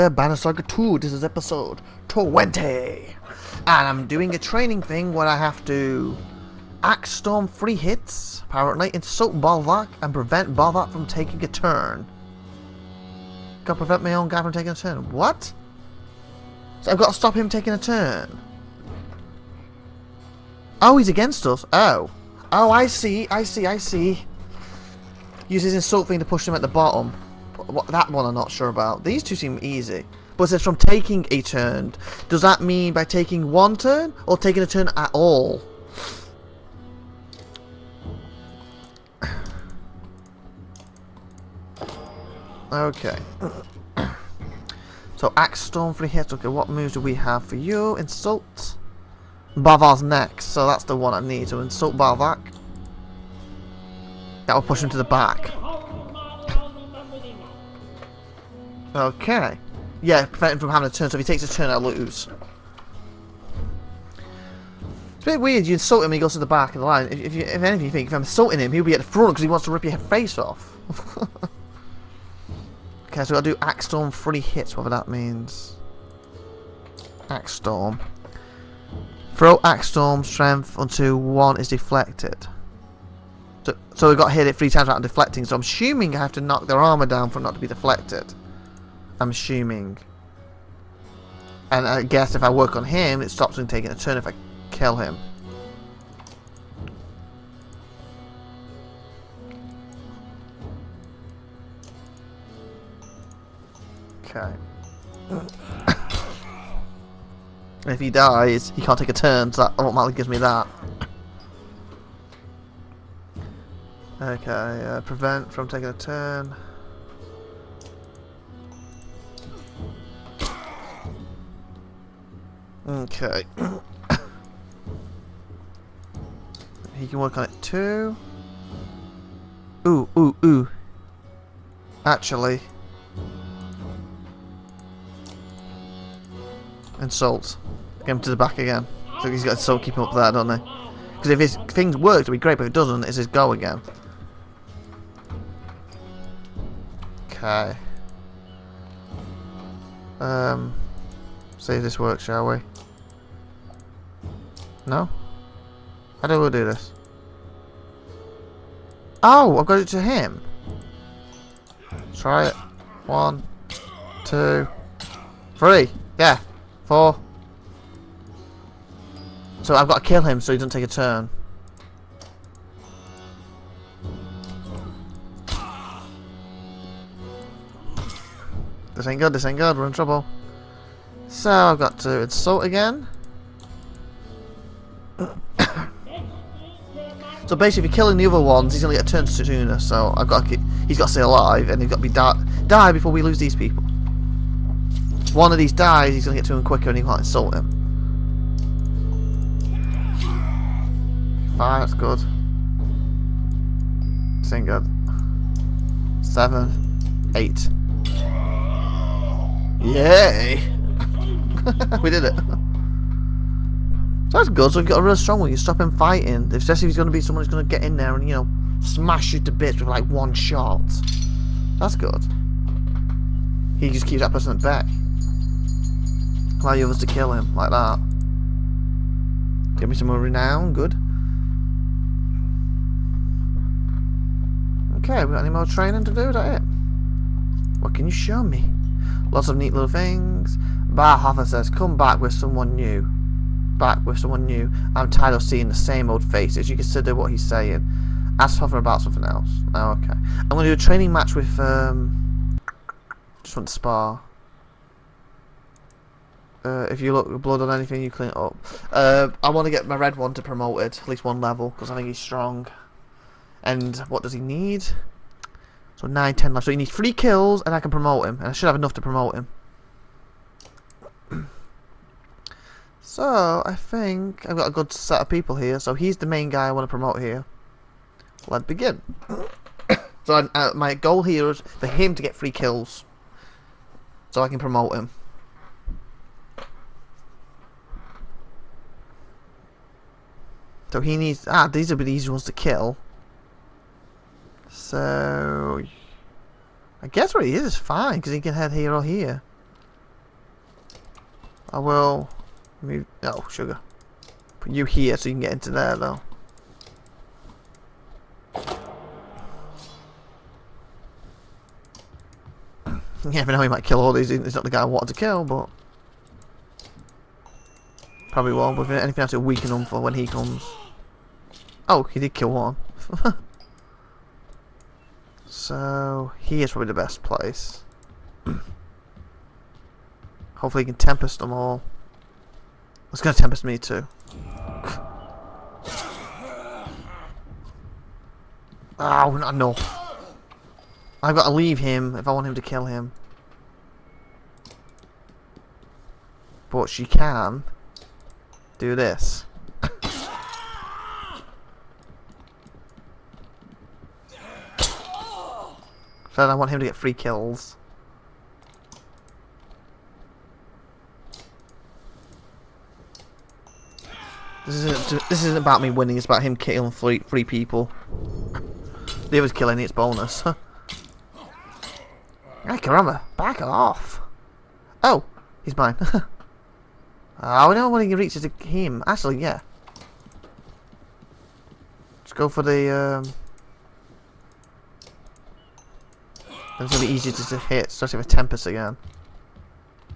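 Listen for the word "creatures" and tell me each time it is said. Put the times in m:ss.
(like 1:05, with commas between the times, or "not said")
not said.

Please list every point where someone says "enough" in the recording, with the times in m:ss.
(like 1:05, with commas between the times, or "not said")
4:28, 5:39.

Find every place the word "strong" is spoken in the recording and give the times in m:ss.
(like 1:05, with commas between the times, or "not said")
3:35, 4:22.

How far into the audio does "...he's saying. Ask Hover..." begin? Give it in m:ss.
4:07.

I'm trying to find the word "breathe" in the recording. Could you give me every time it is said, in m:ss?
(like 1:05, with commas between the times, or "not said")
not said.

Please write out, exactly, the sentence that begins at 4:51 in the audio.
Ah, these are the easy ones to kill.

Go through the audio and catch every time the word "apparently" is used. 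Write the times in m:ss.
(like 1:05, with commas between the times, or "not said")
0:08.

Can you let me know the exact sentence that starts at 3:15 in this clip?
one of these dies, he's going to get to him quicker, and he can't insult him.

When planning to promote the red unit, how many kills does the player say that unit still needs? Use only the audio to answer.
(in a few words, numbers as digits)
3.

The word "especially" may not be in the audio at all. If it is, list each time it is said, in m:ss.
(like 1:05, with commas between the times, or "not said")
3:36, 6:27.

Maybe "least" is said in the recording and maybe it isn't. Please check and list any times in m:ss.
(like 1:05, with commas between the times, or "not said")
4:21.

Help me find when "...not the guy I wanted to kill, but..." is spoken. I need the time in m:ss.
5:14.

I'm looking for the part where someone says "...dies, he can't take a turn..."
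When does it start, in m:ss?
1:48.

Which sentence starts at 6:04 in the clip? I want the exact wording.
This isn't this isn't about me winning.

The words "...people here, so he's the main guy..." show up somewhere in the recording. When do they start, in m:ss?
4:35.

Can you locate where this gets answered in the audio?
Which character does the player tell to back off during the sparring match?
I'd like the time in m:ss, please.
6:12.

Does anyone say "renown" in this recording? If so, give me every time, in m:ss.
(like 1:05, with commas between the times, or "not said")
3:50.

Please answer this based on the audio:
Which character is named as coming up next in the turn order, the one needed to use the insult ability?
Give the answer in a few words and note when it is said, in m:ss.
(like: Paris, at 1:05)
Bavar, at 0:49.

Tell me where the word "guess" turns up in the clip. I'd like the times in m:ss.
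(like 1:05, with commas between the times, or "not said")
1:32, 4:57.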